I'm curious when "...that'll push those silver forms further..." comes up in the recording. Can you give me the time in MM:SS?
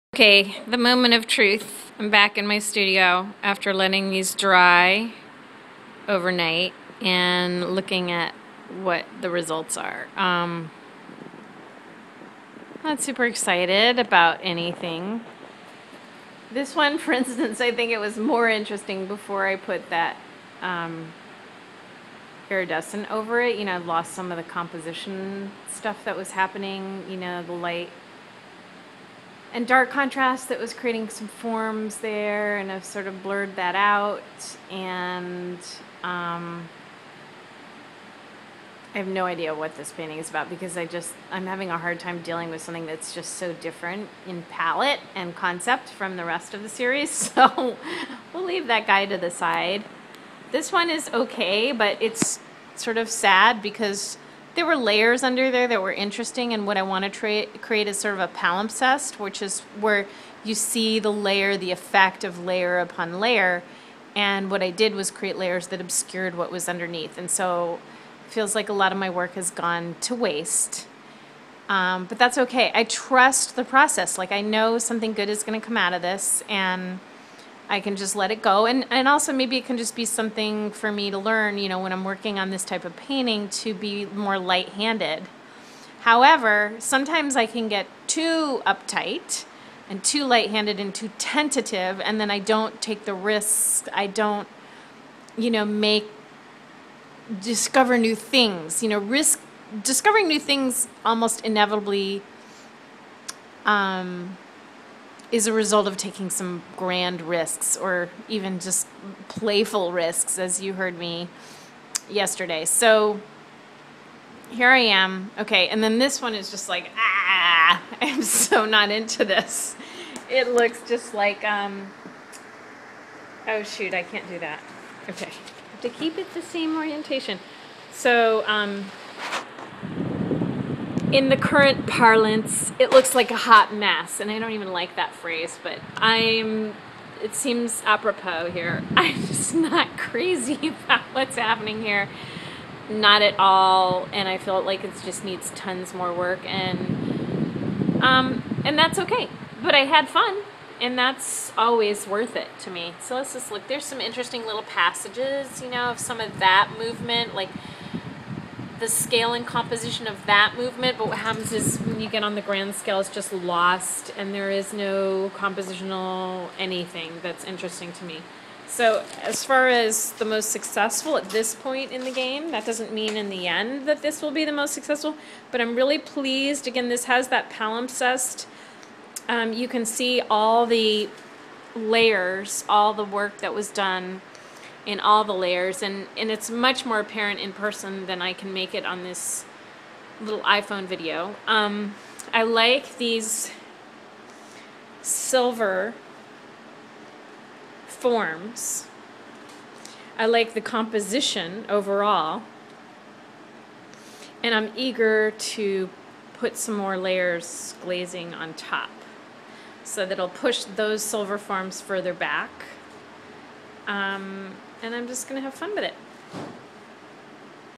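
03:30.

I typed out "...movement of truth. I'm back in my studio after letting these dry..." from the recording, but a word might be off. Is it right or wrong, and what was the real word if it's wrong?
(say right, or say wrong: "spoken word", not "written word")
wrong: "moment", not "movement".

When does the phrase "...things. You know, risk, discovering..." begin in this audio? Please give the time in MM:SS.
01:38.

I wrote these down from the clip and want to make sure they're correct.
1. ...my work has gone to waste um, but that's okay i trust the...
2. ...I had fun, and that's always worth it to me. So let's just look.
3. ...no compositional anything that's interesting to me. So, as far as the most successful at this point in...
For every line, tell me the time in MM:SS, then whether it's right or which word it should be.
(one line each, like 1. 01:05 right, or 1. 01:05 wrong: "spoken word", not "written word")
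1. 01:08 right
2. 02:29 right
3. 02:44 right.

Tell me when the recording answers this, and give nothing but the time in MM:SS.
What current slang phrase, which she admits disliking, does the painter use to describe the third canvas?
02:13.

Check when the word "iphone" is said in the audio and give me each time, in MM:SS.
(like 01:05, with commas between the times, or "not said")
03:10.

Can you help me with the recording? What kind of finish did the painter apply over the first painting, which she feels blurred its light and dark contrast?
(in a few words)
iridescent.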